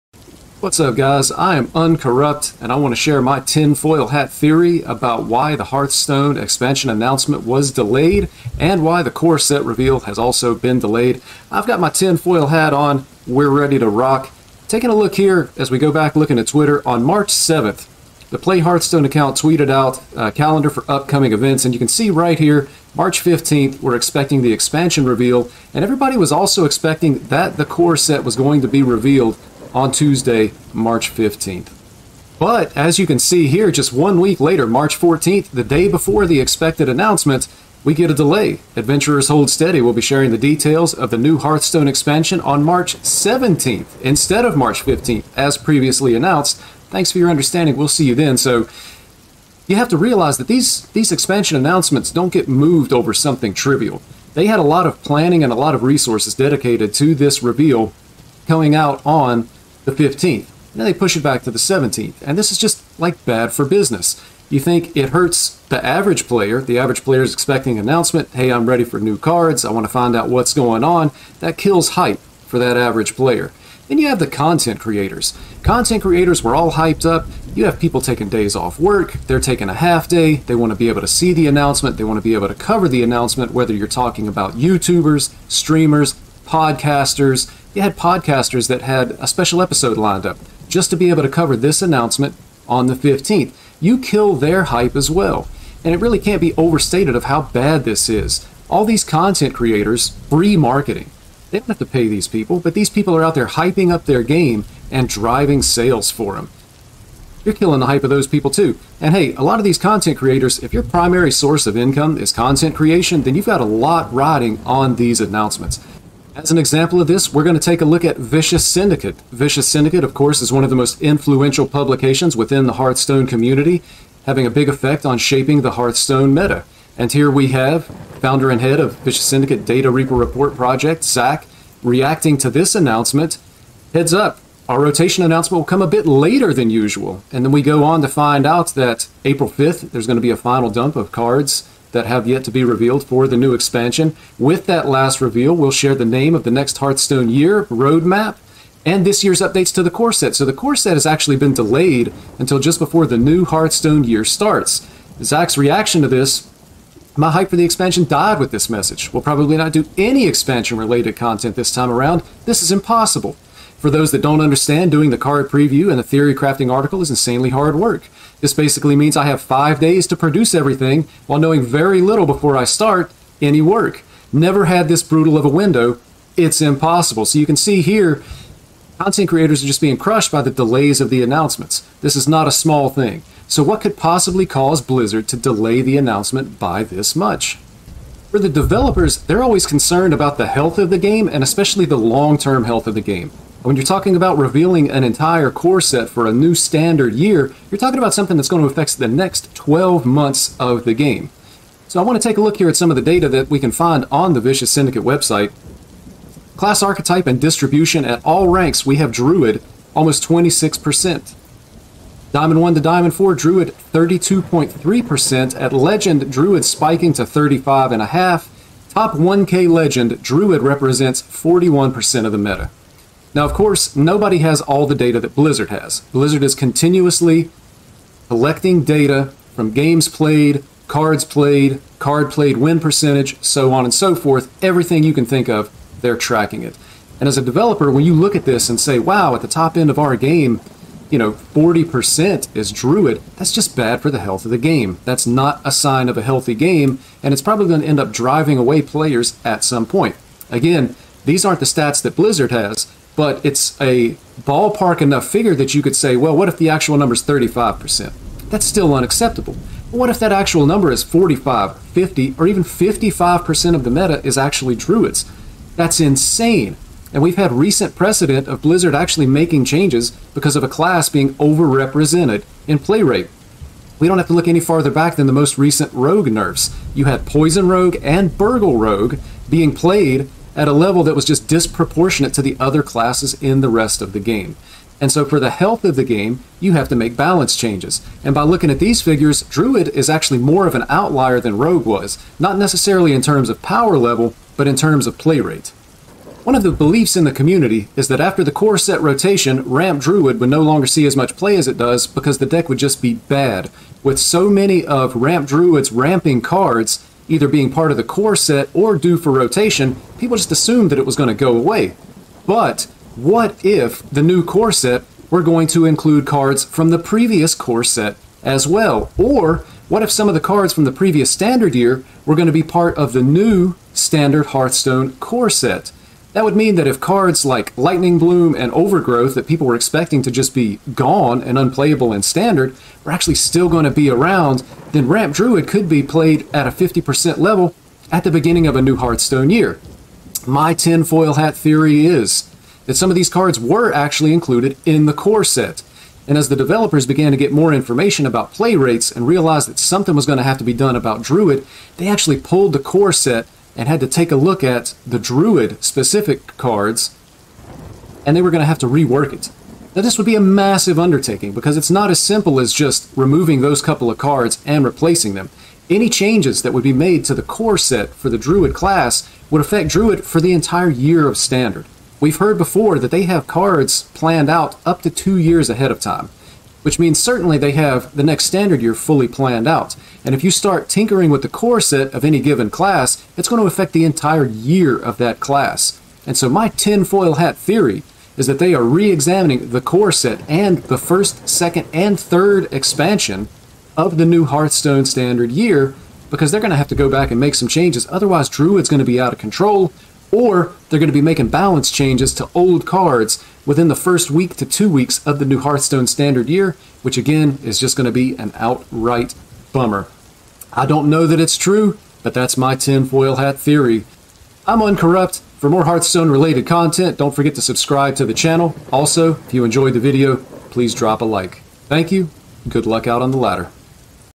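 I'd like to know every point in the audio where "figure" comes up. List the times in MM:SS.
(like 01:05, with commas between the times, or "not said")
04:15, 04:49.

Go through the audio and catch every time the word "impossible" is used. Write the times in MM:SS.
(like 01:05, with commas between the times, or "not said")
02:42, 02:56.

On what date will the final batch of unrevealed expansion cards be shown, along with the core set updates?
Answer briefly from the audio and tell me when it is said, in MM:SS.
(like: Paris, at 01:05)
April 5th, at 02:19.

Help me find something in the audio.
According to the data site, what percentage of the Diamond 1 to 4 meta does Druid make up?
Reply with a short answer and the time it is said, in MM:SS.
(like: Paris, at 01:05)
32.3%, at 03:33.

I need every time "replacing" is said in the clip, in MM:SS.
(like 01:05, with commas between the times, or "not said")
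06:04.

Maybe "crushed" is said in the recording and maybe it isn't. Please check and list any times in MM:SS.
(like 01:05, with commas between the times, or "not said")
02:59.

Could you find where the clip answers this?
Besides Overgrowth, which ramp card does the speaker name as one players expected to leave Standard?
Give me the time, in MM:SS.
05:27.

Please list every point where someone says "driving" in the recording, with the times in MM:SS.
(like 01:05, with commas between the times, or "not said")
01:45, 04:08.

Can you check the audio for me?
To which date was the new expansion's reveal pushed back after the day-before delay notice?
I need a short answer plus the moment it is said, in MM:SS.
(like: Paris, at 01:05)
March 17th, at 00:42.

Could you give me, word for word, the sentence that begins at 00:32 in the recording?
But as you can see here, just one week later, March 14th, the day before the expected announcement, we get a delay.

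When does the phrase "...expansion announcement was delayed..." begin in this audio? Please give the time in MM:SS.
00:06.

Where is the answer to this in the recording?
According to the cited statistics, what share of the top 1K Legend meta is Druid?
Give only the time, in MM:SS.
03:41.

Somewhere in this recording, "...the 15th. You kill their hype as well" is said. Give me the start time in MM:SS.
01:32.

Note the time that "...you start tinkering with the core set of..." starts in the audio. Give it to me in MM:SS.
06:20.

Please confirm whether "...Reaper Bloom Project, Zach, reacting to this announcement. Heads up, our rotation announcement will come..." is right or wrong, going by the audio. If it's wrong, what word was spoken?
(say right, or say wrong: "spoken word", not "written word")
wrong: "Report", not "Bloom".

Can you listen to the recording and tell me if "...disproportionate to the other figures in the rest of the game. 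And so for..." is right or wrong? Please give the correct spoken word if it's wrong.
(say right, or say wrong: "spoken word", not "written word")
wrong: "classes", not "figures".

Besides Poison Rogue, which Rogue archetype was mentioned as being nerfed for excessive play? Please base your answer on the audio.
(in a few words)
Burgle Rogue.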